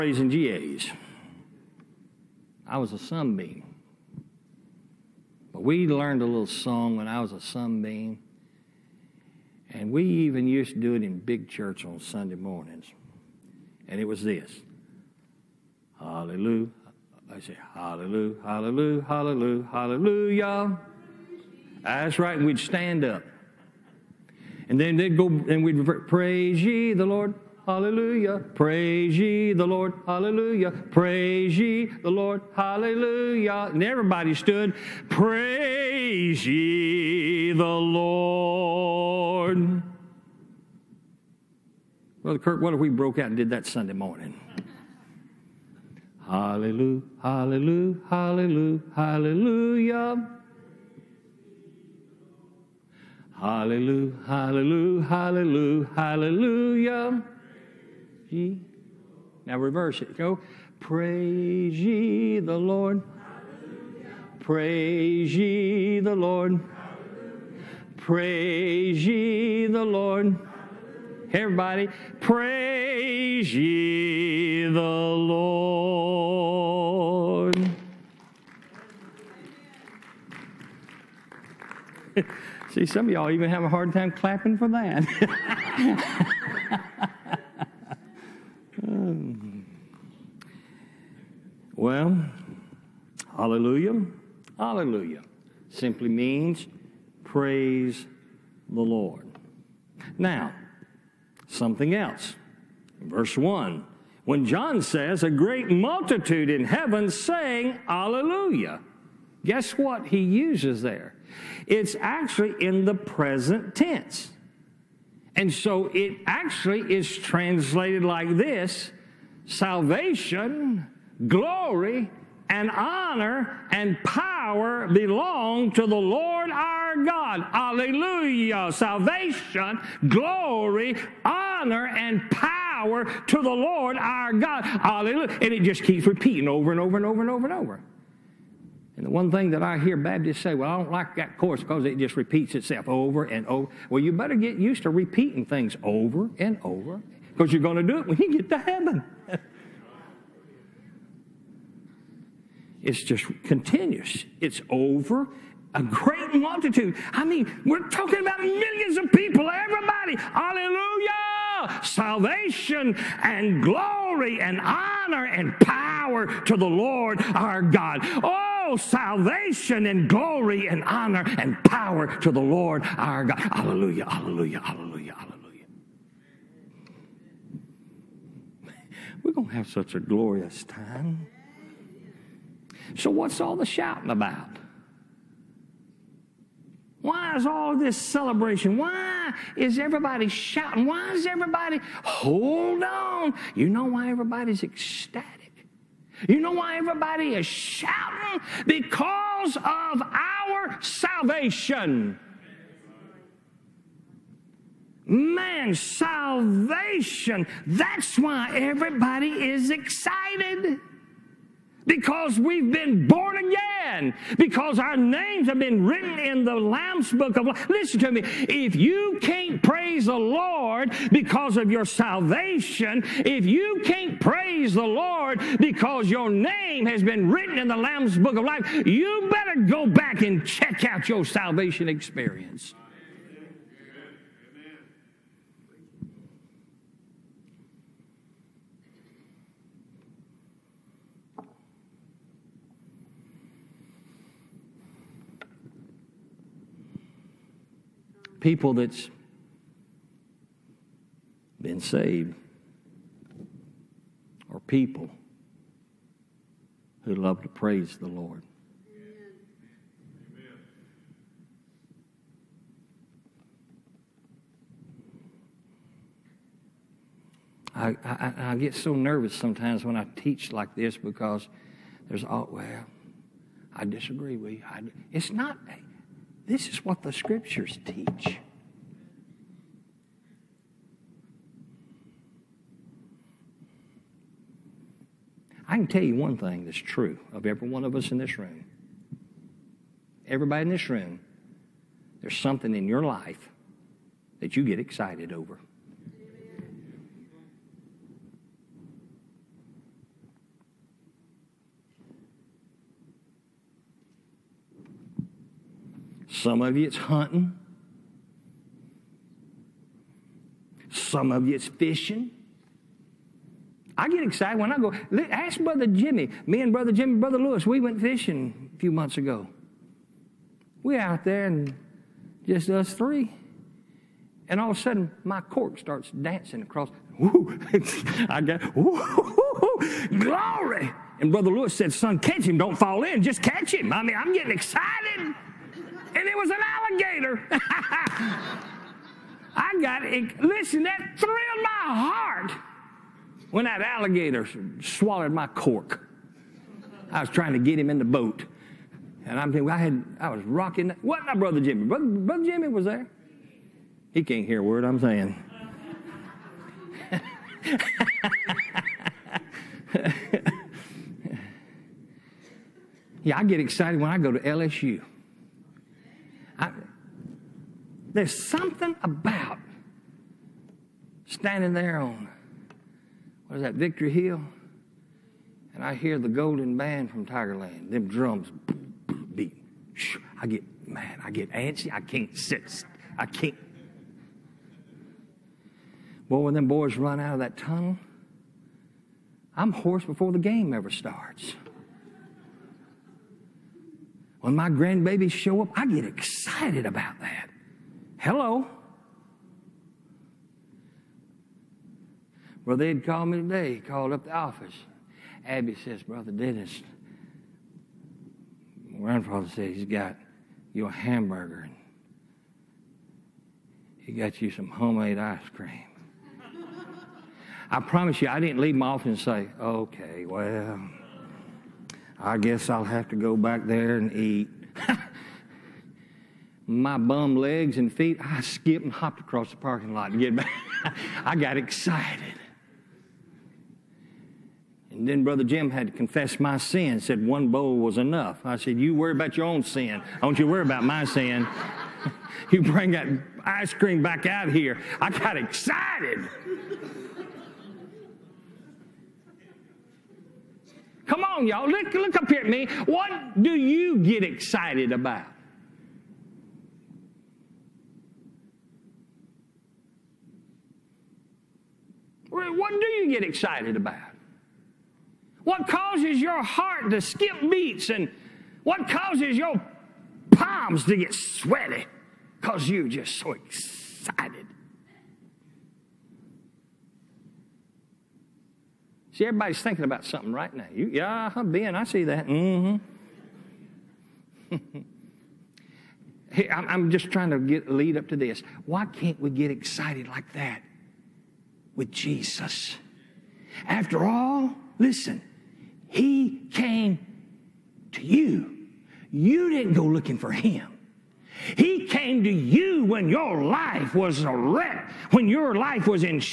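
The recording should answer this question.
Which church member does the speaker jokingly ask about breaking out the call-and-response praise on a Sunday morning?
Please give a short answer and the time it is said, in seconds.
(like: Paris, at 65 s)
Brother Kirk, at 42 s.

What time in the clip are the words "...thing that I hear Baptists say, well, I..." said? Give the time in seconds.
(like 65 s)
139 s.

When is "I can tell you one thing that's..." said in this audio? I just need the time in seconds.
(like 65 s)
285 s.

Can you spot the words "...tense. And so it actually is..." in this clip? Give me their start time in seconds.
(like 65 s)
113 s.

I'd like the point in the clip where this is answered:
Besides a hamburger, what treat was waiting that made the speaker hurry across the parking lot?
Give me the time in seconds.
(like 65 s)
414 s.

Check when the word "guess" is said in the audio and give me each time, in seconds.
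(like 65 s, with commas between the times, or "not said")
109 s, 422 s.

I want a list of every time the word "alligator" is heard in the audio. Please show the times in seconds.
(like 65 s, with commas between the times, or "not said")
336 s, 343 s.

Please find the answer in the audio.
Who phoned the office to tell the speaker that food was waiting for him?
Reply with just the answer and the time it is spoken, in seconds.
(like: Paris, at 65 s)
Abby, at 405 s.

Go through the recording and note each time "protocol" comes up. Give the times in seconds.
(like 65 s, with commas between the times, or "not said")
not said.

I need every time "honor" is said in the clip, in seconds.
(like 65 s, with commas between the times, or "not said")
122 s, 131 s, 164 s, 170 s.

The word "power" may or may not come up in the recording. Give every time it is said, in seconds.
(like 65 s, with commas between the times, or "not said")
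124 s, 132 s, 165 s, 171 s.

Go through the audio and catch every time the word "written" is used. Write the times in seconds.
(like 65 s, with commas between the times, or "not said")
215 s, 227 s.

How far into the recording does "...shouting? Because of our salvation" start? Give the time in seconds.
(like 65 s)
197 s.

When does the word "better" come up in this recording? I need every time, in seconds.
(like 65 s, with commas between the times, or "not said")
144 s, 229 s.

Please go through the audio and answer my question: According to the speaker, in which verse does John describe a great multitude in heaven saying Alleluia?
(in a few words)
Verse 1.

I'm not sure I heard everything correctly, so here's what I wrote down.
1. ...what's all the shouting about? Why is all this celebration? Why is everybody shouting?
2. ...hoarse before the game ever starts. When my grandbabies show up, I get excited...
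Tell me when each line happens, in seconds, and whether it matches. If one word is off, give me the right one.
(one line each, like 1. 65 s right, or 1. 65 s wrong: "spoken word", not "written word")
1. 183 s right
2. 389 s right.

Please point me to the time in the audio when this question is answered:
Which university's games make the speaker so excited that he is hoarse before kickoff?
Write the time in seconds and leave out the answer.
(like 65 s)
364 s.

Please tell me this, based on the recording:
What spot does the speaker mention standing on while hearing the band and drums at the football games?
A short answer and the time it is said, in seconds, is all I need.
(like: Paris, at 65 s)
Victory Hill, at 373 s.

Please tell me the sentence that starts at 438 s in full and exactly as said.
I said, You worry about your own sin.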